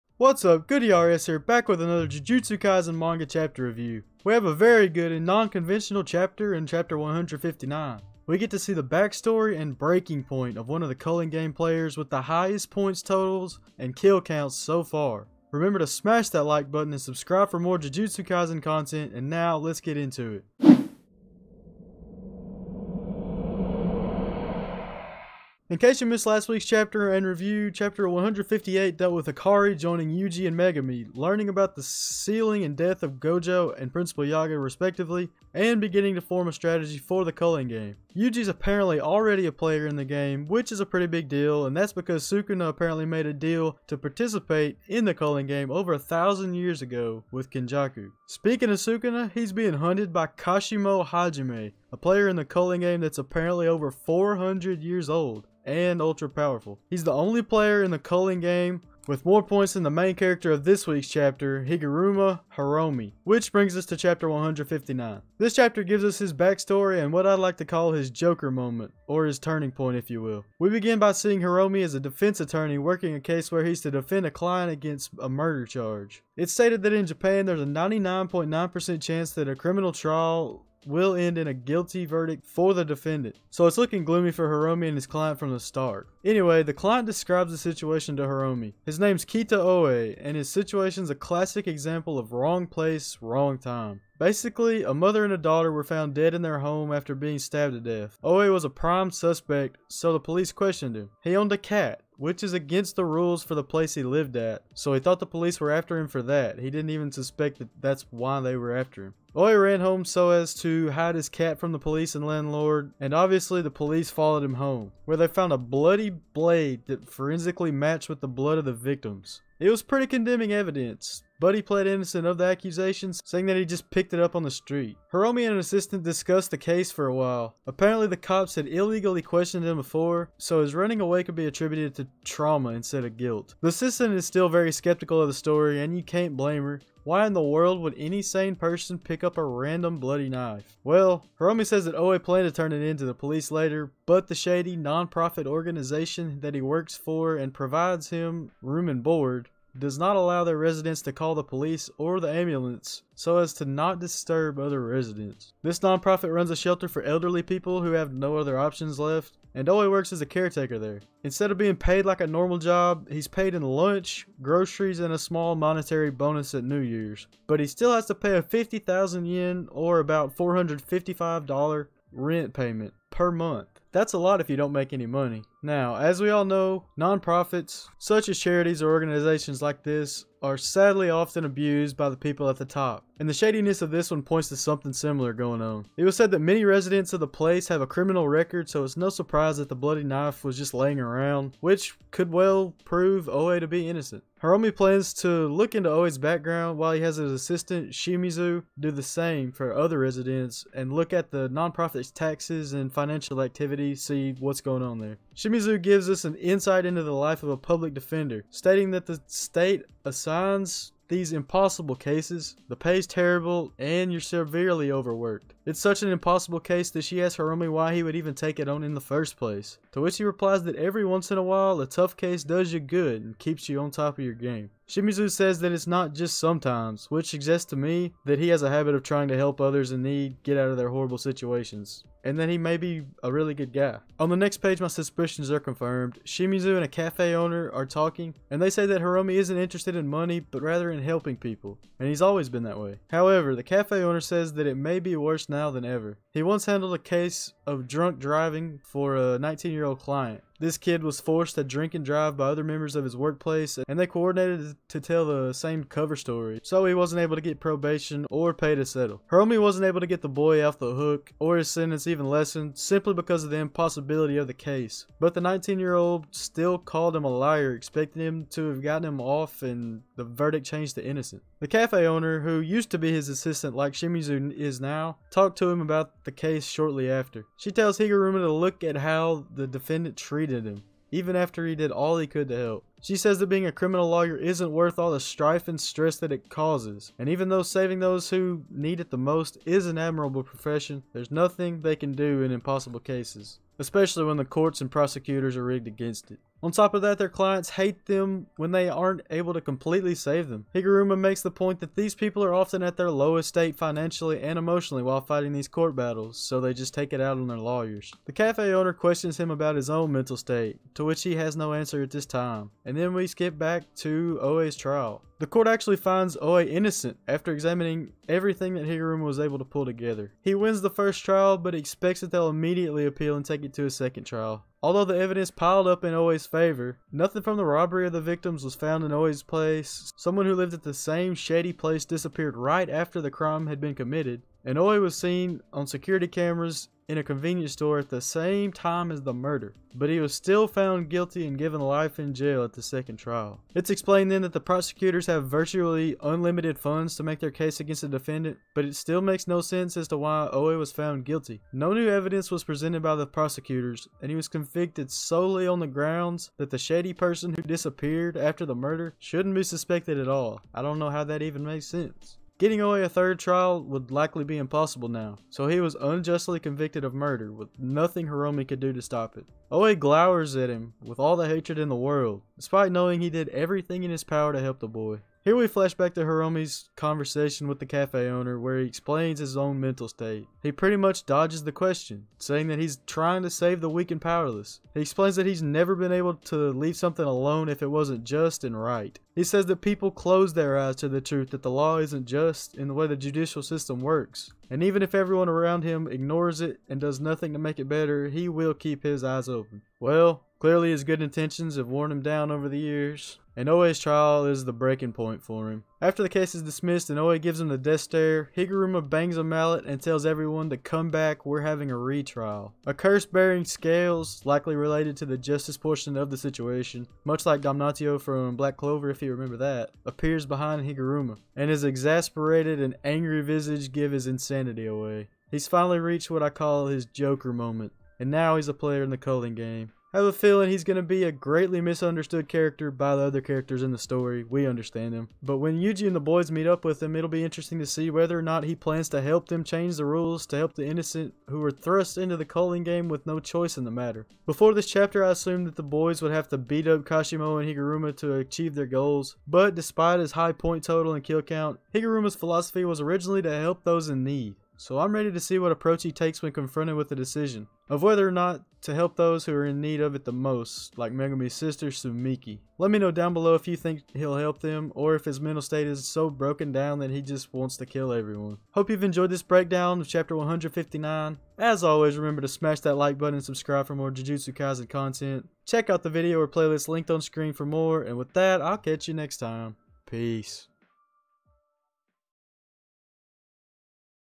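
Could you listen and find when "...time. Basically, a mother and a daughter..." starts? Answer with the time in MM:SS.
01:33.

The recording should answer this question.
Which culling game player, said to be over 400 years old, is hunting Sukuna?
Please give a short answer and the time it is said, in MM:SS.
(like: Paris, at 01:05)
Kashimo Hajime, at 00:50.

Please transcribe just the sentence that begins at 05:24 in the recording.
Although the evidence piled up in Oe's favor, nothing from the robbery of the victims was found in Oe's place.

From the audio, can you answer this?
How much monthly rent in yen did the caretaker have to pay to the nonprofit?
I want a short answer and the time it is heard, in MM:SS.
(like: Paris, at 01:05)
50,000 yen, at 02:48.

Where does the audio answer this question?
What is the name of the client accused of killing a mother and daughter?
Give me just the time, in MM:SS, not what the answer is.
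01:29.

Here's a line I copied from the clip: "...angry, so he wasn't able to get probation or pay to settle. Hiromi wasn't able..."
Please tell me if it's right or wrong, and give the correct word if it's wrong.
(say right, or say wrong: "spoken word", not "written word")
wrong: "story", not "angry".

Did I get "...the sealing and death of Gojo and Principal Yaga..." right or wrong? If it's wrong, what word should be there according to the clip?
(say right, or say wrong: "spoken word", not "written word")
right.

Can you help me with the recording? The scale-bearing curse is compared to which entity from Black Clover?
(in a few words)
Damnatio.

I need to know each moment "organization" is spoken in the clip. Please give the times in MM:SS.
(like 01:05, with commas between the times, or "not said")
02:25, 02:58.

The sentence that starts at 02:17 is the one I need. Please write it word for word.
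Why in the world would any sane person pick up a random bloody knife?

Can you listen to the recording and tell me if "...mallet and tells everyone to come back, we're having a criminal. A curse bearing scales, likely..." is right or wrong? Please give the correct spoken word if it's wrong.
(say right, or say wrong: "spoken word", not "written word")
wrong: "retrial", not "criminal".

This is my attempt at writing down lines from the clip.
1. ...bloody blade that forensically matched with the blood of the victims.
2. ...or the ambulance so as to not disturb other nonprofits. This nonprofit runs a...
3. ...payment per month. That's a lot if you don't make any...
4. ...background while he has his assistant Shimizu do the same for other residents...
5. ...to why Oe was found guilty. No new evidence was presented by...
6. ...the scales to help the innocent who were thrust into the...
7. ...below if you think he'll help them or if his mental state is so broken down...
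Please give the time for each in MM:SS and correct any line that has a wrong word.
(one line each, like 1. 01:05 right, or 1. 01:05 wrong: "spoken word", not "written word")
1. 01:55 right
2. 02:31 wrong: "residents", not "nonprofits"
3. 02:52 right
4. 03:16 right
5. 05:50 right
6. 07:19 wrong: "rules", not "scales"
7. 07:43 right.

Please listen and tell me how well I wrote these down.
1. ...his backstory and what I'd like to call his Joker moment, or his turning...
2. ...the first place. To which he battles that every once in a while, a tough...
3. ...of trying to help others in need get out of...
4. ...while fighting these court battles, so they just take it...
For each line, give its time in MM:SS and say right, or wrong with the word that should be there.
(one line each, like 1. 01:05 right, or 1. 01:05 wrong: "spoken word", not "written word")
1. 01:06 right
2. 03:38 wrong: "replies", not "battles"
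3. 03:48 right
4. 05:05 right.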